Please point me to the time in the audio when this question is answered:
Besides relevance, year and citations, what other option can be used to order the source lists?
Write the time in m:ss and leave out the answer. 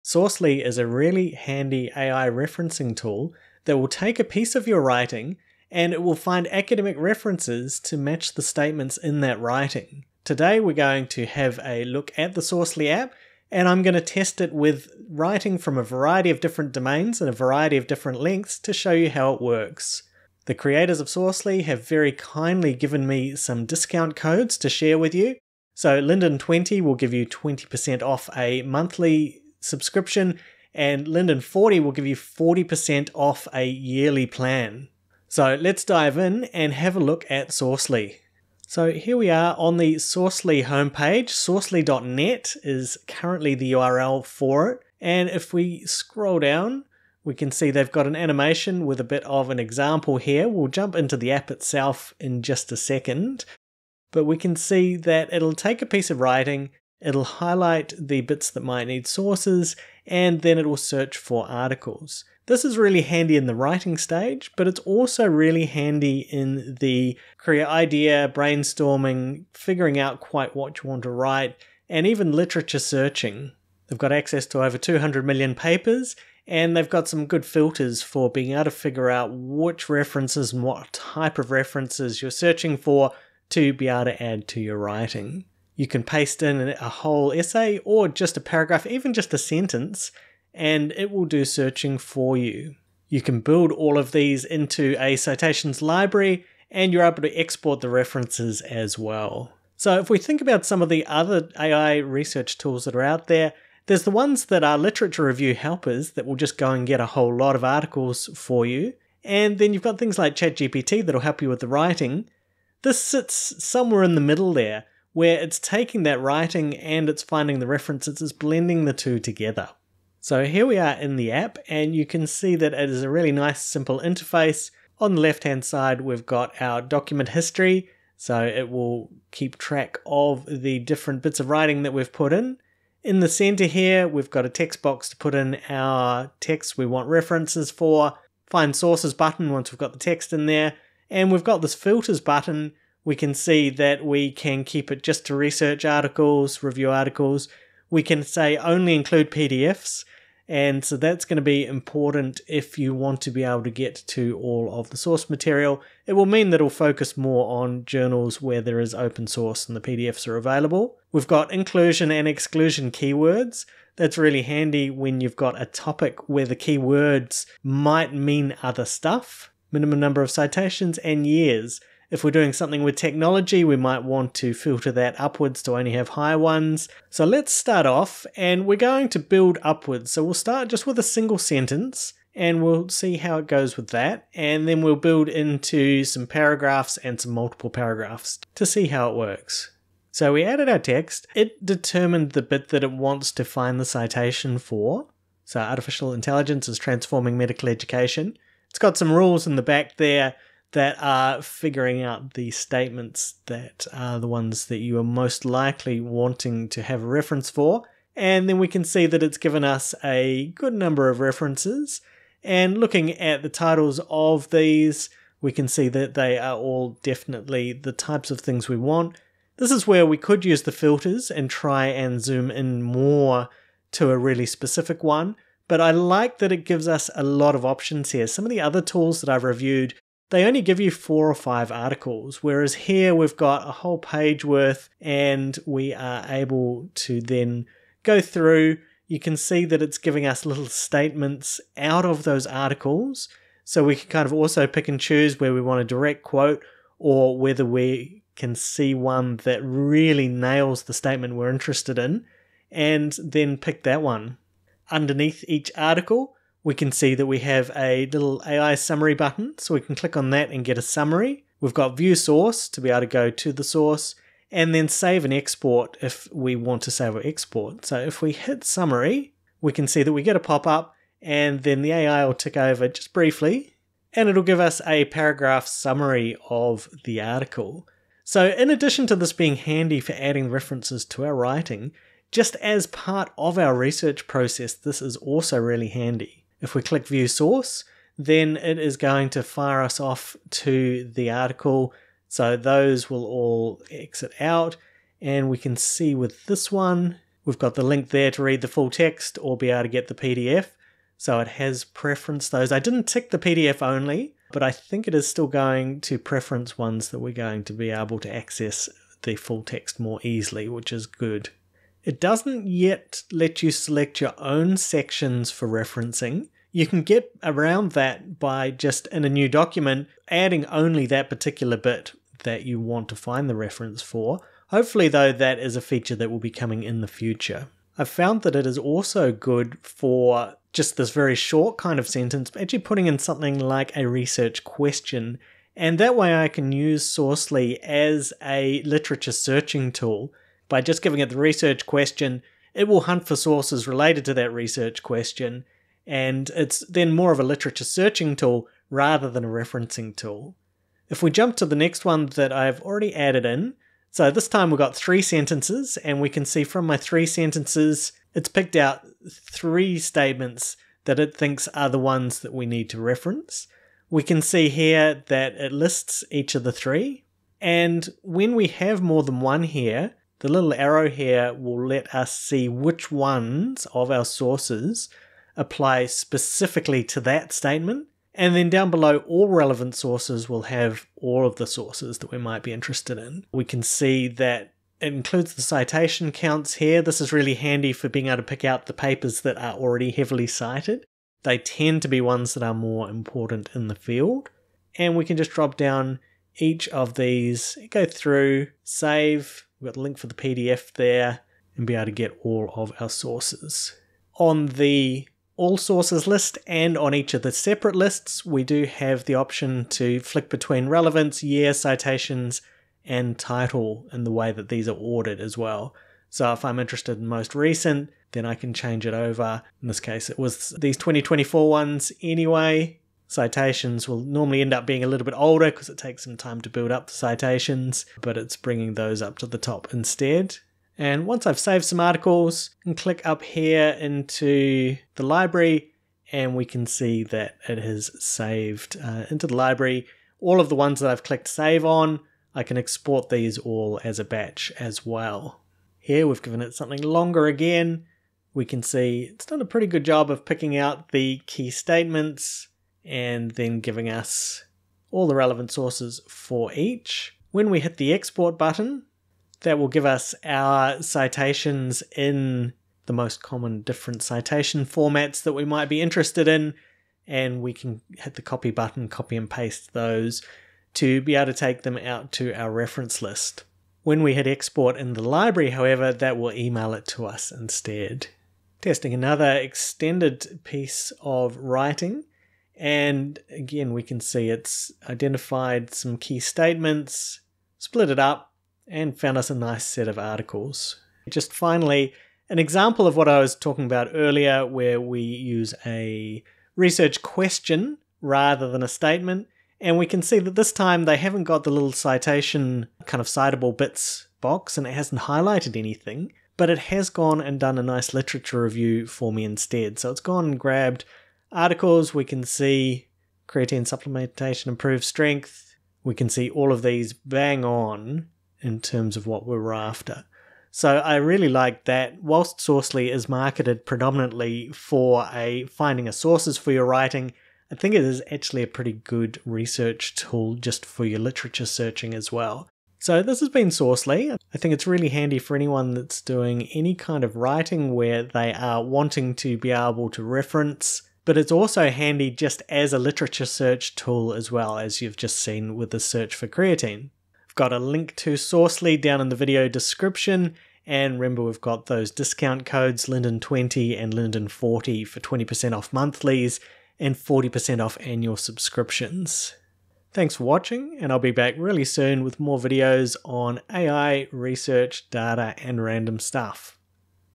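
6:53.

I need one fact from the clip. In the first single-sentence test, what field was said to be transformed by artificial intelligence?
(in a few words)
Medical education.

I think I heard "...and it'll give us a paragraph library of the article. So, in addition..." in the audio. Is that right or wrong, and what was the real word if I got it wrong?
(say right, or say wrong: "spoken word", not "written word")
wrong: "summary", not "library".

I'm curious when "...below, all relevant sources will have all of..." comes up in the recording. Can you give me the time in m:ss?
6:18.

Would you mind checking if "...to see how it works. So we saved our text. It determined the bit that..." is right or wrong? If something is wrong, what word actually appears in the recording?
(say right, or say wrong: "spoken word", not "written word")
wrong: "added", not "saved".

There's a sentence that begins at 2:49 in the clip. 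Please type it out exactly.
Minimum number of citations and years.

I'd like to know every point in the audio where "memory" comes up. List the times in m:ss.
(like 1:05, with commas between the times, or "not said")
not said.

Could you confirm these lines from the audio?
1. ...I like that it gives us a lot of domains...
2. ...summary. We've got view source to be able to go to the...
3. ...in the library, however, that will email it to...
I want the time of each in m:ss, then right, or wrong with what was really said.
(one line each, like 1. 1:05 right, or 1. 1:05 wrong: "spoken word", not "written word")
1. 3:45 wrong: "options", not "domains"
2. 4:20 right
3. 7:54 right.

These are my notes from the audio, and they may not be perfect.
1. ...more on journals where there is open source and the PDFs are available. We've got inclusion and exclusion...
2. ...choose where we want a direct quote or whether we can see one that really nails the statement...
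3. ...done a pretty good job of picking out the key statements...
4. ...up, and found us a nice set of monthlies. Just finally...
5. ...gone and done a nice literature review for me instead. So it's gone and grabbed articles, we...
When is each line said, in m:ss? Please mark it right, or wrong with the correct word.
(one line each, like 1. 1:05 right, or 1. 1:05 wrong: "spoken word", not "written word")
1. 2:37 right
2. 4:04 right
3. 7:29 right
4. 8:08 wrong: "articles", not "monthlies"
5. 8:27 right.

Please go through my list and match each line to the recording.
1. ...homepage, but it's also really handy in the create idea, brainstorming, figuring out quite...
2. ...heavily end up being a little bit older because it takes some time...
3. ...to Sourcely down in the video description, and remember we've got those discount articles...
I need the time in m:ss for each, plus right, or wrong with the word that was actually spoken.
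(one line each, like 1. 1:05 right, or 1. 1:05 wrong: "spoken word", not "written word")
1. 1:03 wrong: "stage", not "homepage"
2. 7:04 wrong: "normally", not "heavily"
3. 9:08 wrong: "codes", not "articles".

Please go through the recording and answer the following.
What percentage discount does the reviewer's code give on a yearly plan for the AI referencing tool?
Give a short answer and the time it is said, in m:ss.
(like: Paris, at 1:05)
40%, at 0:32.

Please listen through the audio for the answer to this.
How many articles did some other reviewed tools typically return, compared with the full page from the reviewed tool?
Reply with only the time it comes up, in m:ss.
3:50.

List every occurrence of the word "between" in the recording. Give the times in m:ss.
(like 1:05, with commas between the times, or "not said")
6:50.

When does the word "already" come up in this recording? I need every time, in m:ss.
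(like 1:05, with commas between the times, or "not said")
5:52, 6:29.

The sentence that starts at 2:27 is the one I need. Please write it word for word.
We can say only include PDFs.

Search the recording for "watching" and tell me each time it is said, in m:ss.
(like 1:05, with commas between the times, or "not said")
9:20.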